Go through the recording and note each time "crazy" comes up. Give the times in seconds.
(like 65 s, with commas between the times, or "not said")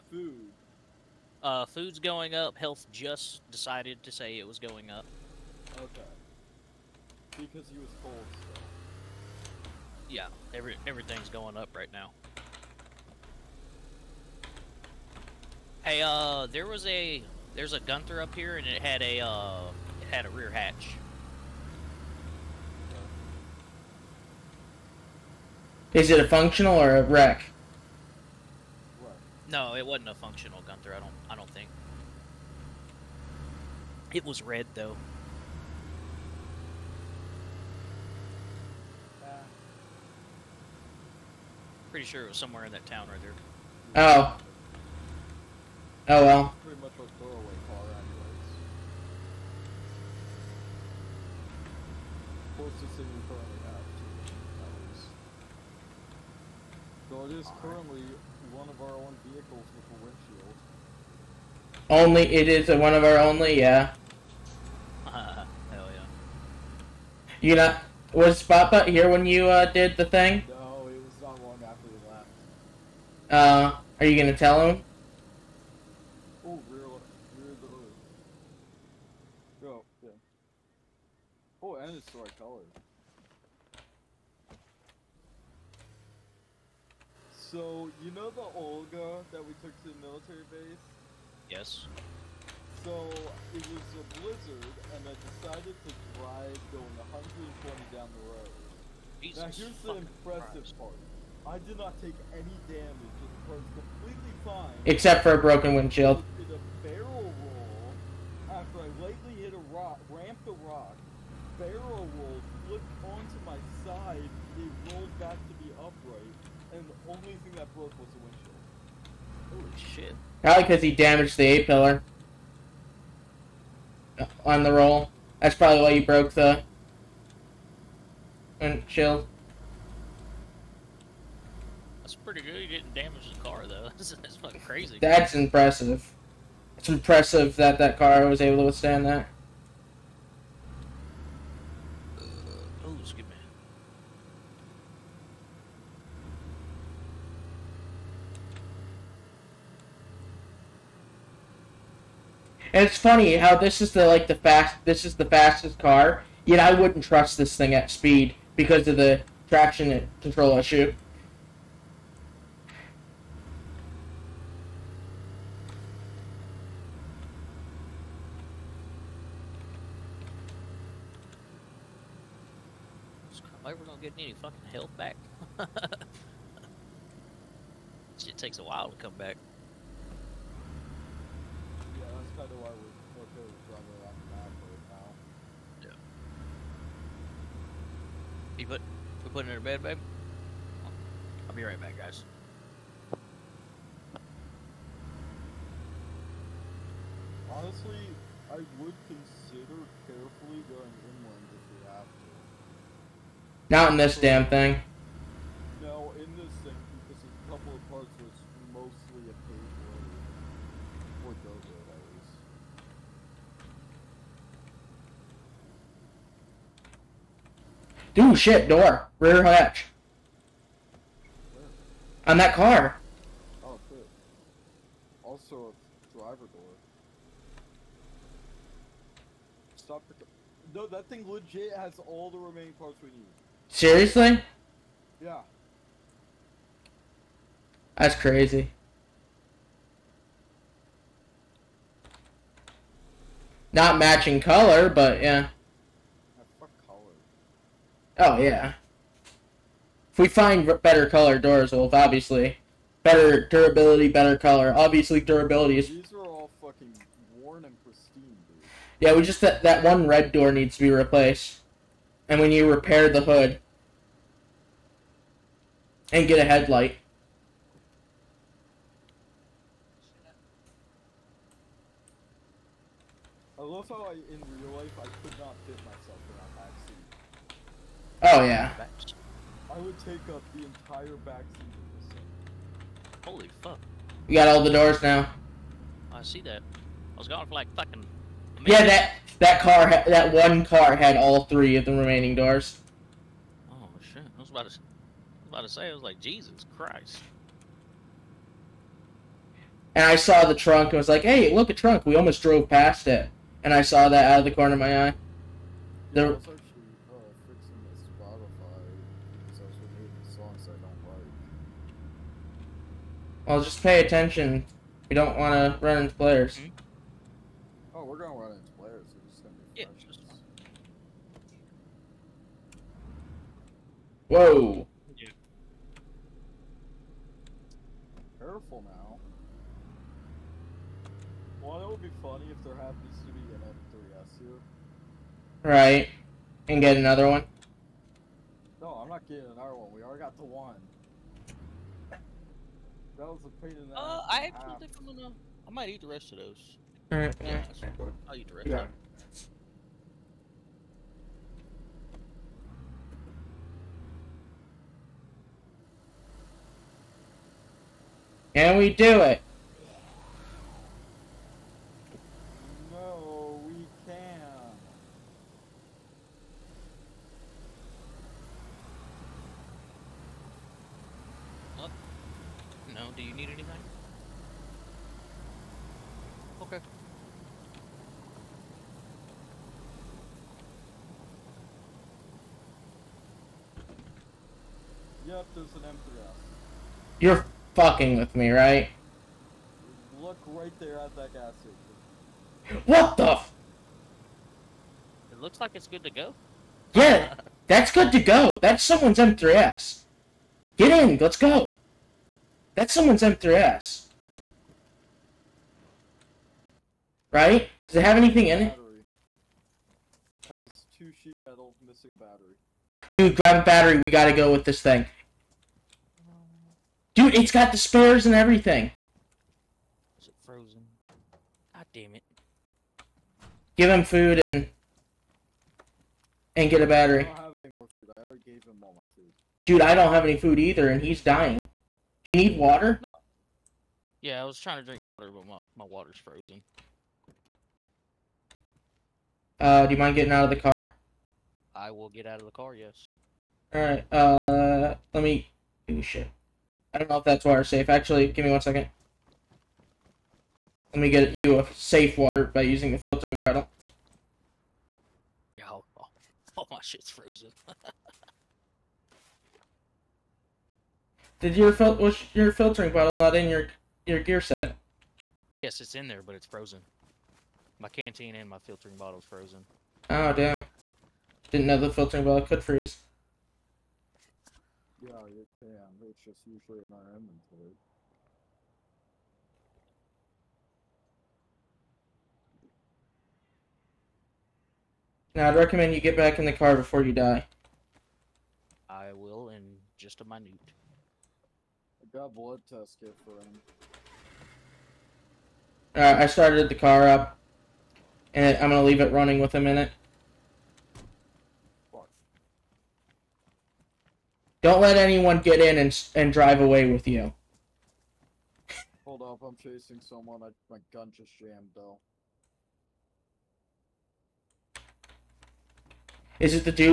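134 s, 238 s.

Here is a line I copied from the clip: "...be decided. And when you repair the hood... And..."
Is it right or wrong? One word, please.
wrong.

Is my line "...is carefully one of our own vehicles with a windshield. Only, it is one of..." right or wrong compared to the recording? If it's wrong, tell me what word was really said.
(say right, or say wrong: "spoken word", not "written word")
wrong: "currently", not "carefully".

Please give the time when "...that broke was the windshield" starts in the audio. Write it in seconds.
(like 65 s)
117 s.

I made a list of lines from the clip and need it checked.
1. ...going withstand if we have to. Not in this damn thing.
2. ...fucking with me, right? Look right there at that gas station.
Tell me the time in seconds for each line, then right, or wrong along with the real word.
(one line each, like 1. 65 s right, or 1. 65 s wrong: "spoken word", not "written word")
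1. 200 s wrong: "inland", not "withstand"
2. 387 s right.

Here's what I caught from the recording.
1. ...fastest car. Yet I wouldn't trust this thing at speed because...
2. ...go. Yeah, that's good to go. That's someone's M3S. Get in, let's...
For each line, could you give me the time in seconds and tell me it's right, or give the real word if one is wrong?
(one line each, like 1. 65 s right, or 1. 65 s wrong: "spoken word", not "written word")
1. 155 s right
2. 396 s right.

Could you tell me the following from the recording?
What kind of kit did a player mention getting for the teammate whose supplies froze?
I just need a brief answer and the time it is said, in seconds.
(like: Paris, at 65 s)
Blood test kit, at 492 s.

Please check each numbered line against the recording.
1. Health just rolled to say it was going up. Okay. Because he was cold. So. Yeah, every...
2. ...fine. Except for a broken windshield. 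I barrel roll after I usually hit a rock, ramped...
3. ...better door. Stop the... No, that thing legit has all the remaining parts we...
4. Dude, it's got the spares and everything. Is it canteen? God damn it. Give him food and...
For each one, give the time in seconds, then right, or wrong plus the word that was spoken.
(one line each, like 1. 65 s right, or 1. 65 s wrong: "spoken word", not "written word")
1. 2 s wrong: "decided", not "rolled"
2. 104 s wrong: "lightly", not "usually"
3. 226 s wrong: "driver", not "better"
4. 417 s wrong: "frozen", not "canteen".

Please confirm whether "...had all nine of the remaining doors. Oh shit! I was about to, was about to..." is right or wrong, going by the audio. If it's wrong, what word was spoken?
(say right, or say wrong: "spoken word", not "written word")
wrong: "three", not "nine".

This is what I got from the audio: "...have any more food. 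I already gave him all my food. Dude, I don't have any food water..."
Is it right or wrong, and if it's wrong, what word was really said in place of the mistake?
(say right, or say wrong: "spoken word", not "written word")
wrong: "either", not "water".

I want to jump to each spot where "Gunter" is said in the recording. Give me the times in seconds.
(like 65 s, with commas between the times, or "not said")
17 s, 30 s.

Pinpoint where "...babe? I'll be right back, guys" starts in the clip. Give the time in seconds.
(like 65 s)
189 s.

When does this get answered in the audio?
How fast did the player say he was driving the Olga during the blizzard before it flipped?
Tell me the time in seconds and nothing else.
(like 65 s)
97 s.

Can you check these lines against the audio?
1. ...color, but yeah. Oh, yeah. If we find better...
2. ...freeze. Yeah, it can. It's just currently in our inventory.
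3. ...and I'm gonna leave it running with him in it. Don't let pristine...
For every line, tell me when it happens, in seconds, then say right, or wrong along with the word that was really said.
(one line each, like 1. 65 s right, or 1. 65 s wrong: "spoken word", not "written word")
1. 244 s right
2. 472 s wrong: "usually", not "currently"
3. 498 s wrong: "anyone", not "pristine".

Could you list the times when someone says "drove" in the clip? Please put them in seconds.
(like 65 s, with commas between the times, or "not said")
302 s.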